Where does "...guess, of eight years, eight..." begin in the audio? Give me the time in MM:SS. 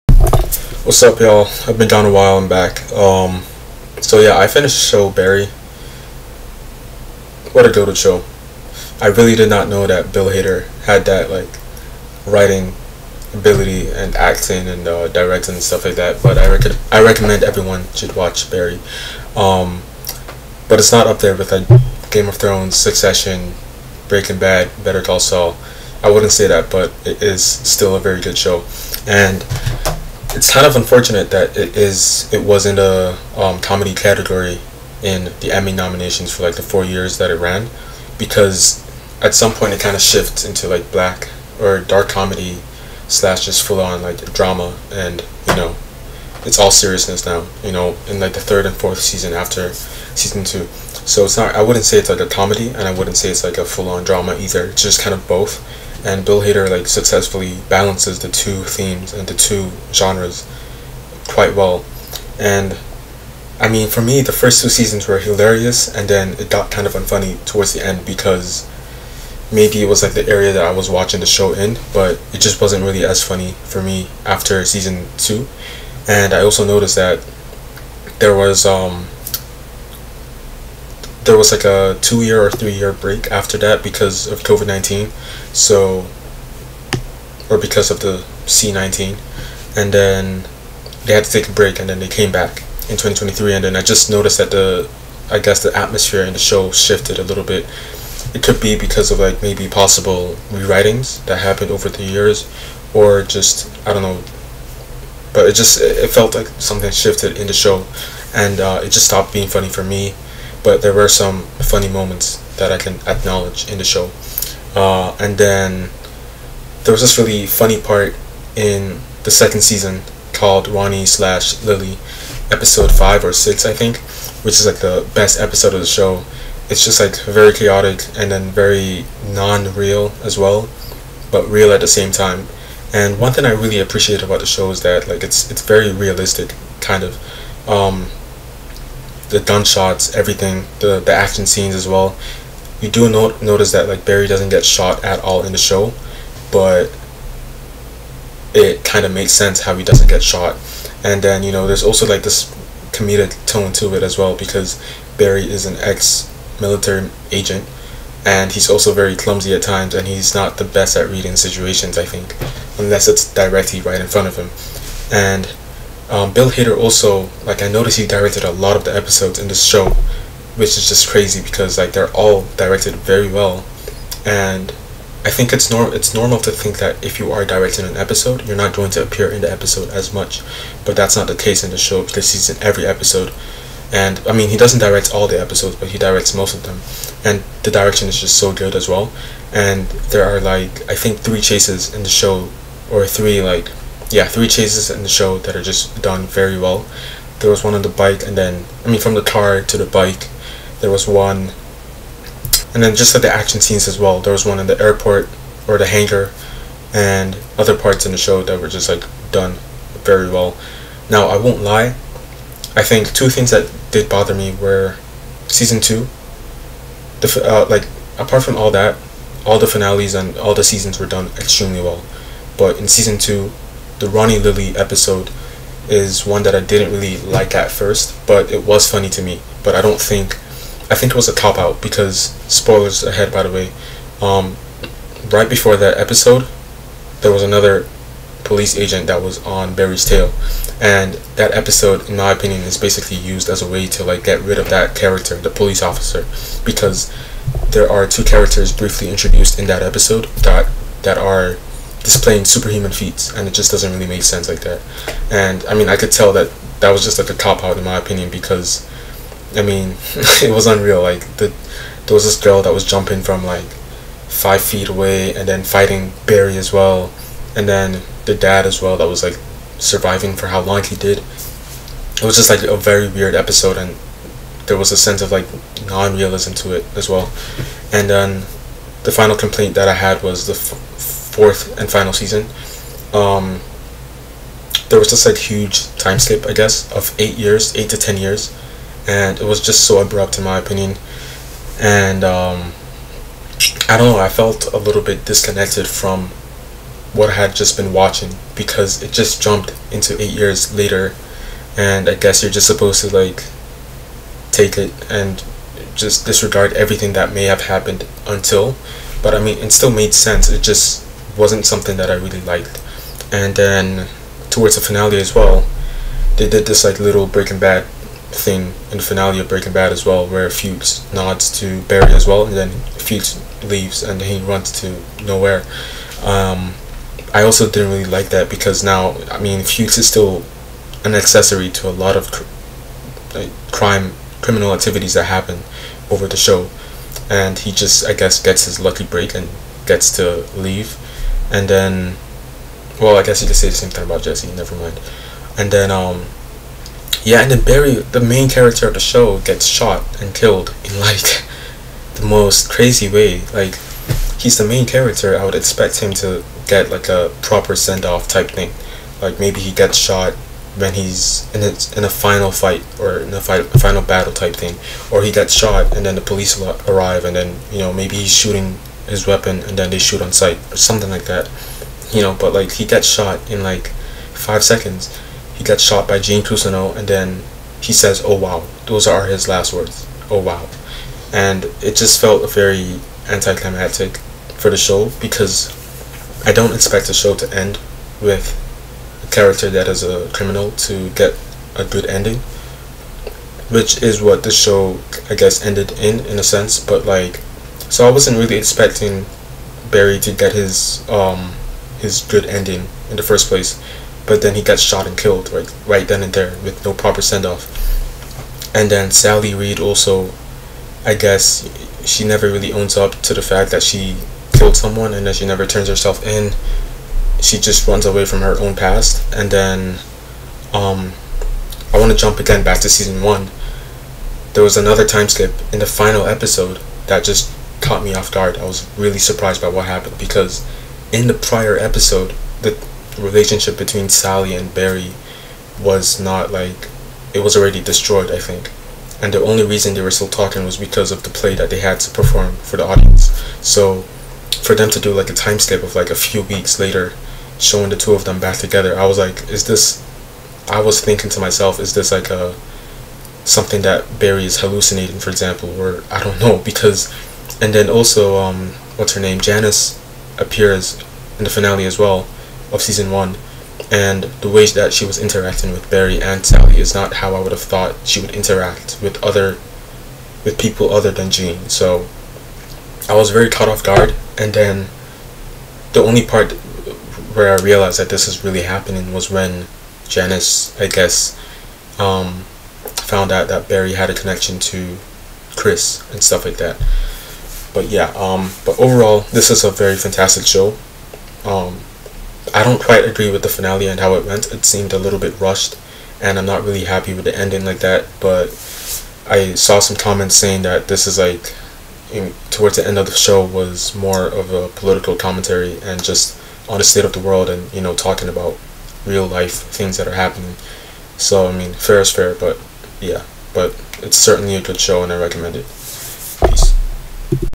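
04:46.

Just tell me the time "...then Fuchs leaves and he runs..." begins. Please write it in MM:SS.
05:22.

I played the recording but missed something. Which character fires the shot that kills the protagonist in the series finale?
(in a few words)
Gene Cousineau.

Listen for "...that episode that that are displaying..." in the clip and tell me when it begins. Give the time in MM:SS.
04:09.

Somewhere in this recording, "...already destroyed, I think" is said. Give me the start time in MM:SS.
07:17.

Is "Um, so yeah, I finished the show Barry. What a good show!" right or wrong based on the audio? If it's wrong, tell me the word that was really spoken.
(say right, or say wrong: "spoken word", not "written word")
right.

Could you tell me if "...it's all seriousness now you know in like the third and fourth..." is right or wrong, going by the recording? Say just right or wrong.
right.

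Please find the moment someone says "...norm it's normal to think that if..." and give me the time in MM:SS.
02:55.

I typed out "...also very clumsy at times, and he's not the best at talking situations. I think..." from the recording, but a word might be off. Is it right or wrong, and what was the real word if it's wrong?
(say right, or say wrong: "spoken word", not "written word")
wrong: "reading", not "talking".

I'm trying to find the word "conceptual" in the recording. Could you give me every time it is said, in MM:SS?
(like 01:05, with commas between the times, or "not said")
not said.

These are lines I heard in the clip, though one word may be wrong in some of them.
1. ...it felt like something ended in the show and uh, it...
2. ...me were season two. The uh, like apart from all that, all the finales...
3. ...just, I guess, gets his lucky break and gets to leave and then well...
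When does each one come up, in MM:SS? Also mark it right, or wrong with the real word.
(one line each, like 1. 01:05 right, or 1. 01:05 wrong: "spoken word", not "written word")
1. 01:45 wrong: "shifted", not "ended"
2. 03:34 right
3. 05:37 right.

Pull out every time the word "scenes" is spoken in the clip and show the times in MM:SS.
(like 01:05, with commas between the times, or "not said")
02:21, 03:23.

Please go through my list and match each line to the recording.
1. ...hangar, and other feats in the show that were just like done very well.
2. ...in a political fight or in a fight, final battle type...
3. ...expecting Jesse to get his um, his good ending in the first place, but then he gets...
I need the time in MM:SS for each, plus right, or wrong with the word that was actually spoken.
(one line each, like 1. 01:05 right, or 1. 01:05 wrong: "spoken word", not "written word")
1. 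03:25 wrong: "parts", not "feats"
2. 06:01 wrong: "final", not "political"
3. 06:38 wrong: "Barry", not "Jesse".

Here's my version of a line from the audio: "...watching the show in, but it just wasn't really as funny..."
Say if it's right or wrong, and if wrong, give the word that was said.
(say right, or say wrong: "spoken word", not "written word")
right.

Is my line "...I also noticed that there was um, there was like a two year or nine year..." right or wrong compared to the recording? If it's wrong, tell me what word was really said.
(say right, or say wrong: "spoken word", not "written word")
wrong: "three", not "nine".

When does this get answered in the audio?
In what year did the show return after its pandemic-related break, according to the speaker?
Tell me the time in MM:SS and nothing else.
01:32.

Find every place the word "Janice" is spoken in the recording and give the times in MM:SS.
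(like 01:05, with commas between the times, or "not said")
07:39, 08:00.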